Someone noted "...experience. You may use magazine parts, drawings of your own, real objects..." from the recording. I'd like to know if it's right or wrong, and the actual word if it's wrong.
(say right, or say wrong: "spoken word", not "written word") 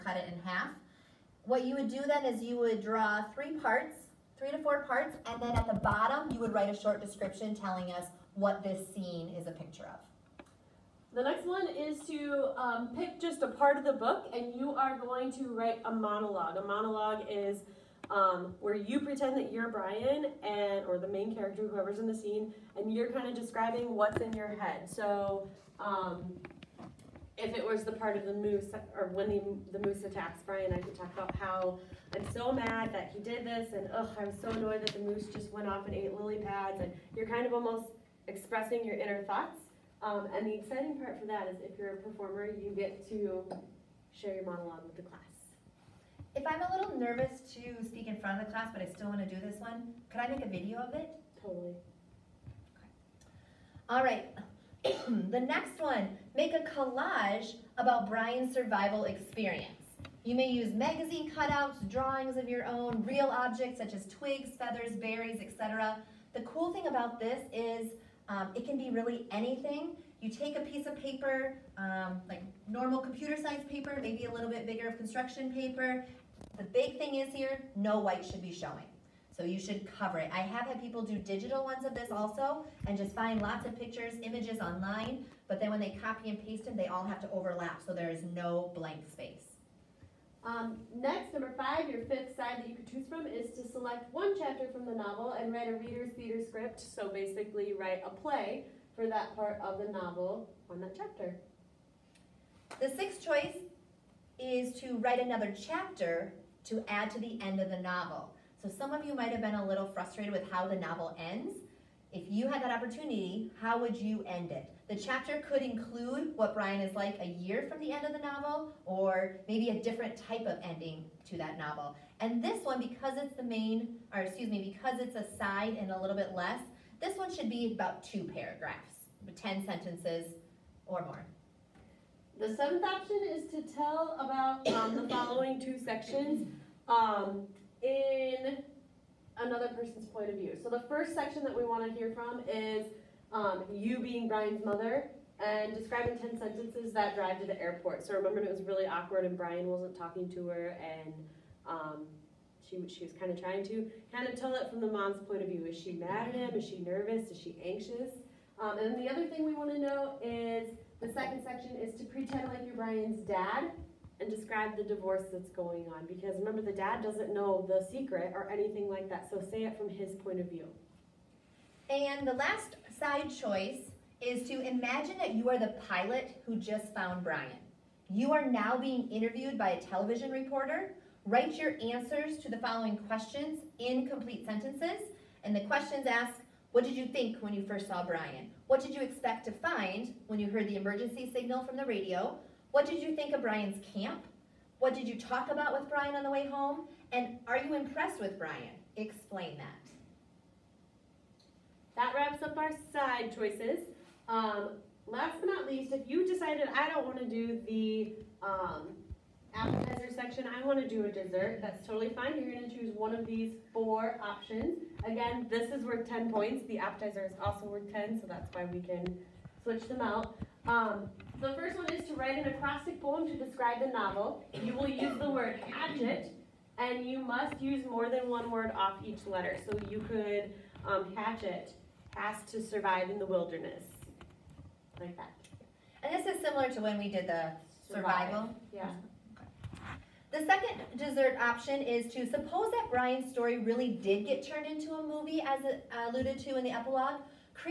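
wrong: "cutouts", not "parts".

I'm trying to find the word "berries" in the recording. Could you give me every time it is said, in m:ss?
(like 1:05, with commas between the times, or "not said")
1:04.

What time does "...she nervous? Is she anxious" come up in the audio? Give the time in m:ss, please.
2:36.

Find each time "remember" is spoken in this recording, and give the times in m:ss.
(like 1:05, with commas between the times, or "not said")
2:28, 2:46.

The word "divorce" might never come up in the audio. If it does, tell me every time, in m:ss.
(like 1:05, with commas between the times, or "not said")
2:44.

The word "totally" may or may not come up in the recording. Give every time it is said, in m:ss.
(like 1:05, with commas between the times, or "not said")
0:51, 3:31.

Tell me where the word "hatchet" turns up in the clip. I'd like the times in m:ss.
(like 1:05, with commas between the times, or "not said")
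3:45, 3:51.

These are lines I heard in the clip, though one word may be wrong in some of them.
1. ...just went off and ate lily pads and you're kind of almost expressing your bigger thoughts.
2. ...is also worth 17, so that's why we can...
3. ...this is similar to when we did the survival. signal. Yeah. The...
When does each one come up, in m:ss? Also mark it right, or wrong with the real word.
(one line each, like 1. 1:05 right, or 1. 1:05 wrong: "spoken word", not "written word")
1. 0:35 wrong: "inner", not "bigger"
2. 3:37 wrong: "10", not "17"
3. 3:56 wrong: "survival", not "signal".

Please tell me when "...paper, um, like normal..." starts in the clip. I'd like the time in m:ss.
1:11.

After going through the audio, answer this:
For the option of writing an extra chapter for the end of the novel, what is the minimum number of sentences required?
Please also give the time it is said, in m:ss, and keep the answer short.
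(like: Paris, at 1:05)
10, at 2:09.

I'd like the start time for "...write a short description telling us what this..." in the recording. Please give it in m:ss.
0:06.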